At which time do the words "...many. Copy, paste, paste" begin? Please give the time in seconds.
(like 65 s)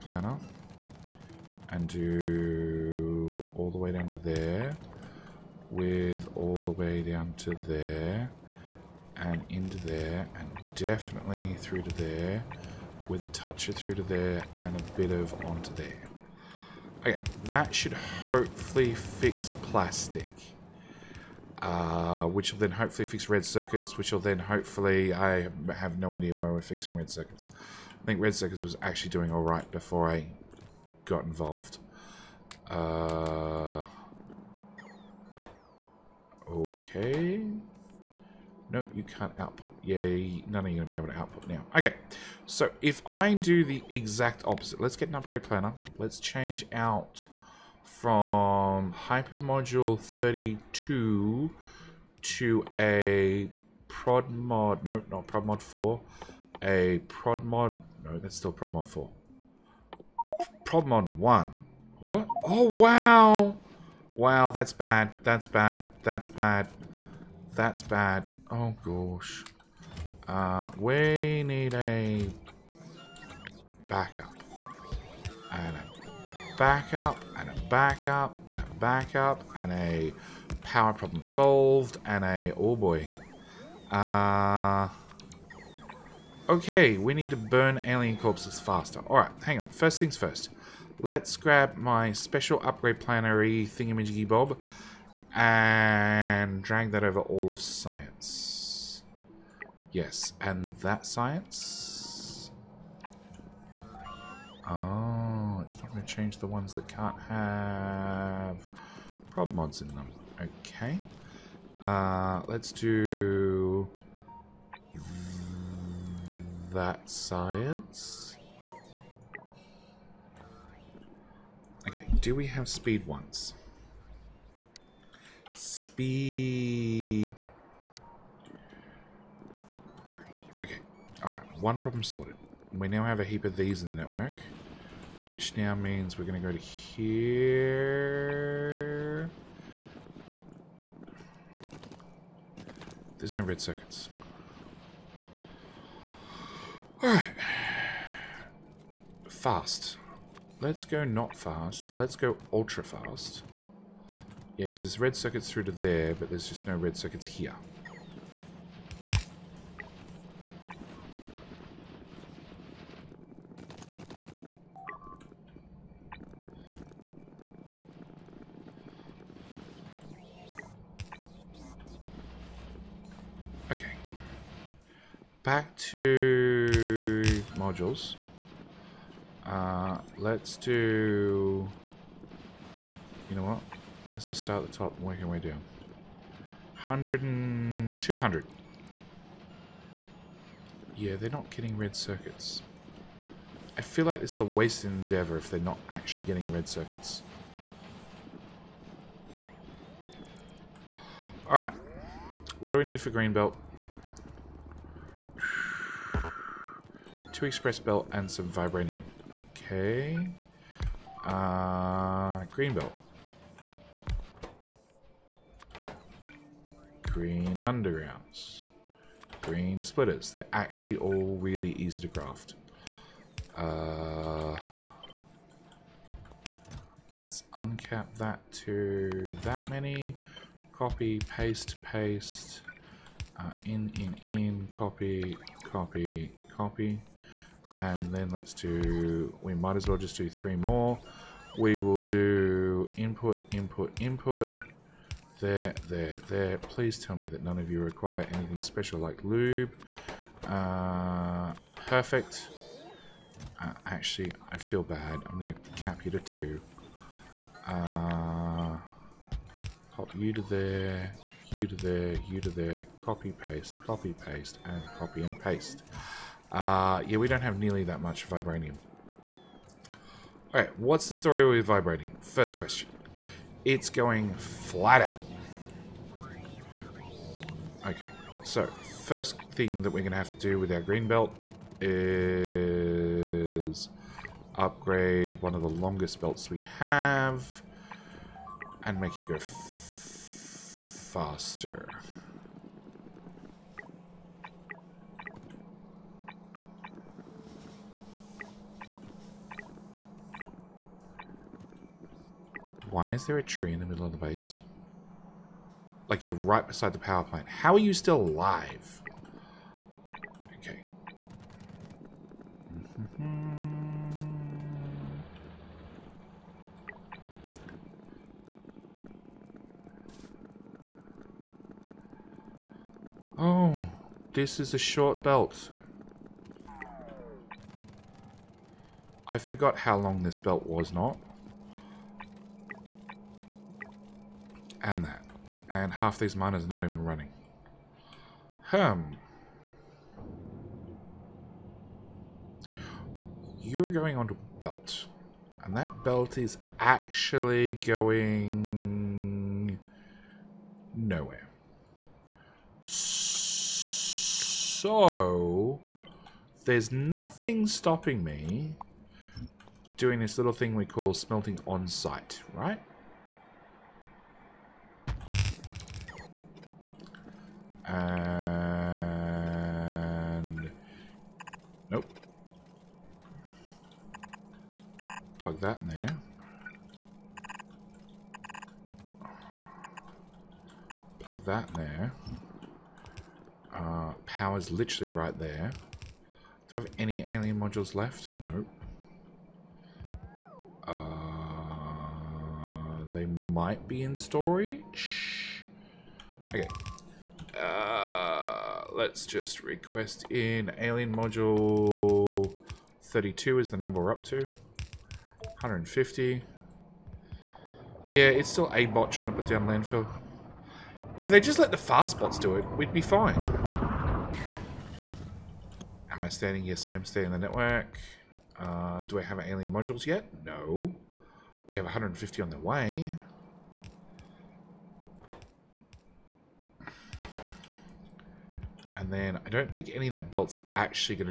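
229 s.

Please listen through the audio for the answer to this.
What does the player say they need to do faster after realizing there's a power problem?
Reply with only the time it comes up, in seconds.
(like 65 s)
87 s.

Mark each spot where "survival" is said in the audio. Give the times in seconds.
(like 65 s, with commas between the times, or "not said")
not said.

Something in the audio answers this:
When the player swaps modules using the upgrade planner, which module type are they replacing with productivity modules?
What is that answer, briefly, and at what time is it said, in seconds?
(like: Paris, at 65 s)
hyper module 32, at 48 s.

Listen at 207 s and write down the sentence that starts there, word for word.
Two express belt and some vibranium.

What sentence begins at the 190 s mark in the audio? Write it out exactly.
Yeah, they're not getting red circuits.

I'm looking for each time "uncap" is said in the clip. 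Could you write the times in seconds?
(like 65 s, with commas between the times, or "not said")
227 s.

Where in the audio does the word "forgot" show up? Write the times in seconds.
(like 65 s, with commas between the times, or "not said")
329 s.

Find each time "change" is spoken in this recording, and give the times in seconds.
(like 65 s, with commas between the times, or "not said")
46 s, 106 s.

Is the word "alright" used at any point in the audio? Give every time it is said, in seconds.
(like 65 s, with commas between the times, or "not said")
29 s, 89 s, 131 s, 147 s, 201 s, 270 s.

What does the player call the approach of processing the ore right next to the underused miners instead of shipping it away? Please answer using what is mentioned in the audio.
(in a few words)
smelting on site.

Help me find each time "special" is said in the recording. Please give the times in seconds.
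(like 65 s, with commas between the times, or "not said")
92 s, 248 s.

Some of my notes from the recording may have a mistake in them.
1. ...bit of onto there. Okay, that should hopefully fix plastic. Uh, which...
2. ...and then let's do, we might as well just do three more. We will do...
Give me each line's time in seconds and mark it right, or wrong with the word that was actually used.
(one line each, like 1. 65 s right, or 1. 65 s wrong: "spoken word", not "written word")
1. 14 s right
2. 237 s right.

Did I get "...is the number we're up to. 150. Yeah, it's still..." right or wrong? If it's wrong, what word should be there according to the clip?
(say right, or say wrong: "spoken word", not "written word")
right.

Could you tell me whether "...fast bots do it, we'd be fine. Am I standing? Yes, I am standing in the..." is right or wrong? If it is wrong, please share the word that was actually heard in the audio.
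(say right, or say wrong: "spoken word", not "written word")
right.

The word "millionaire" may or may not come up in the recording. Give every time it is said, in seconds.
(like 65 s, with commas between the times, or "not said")
not said.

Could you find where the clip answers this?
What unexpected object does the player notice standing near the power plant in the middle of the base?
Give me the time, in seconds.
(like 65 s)
303 s.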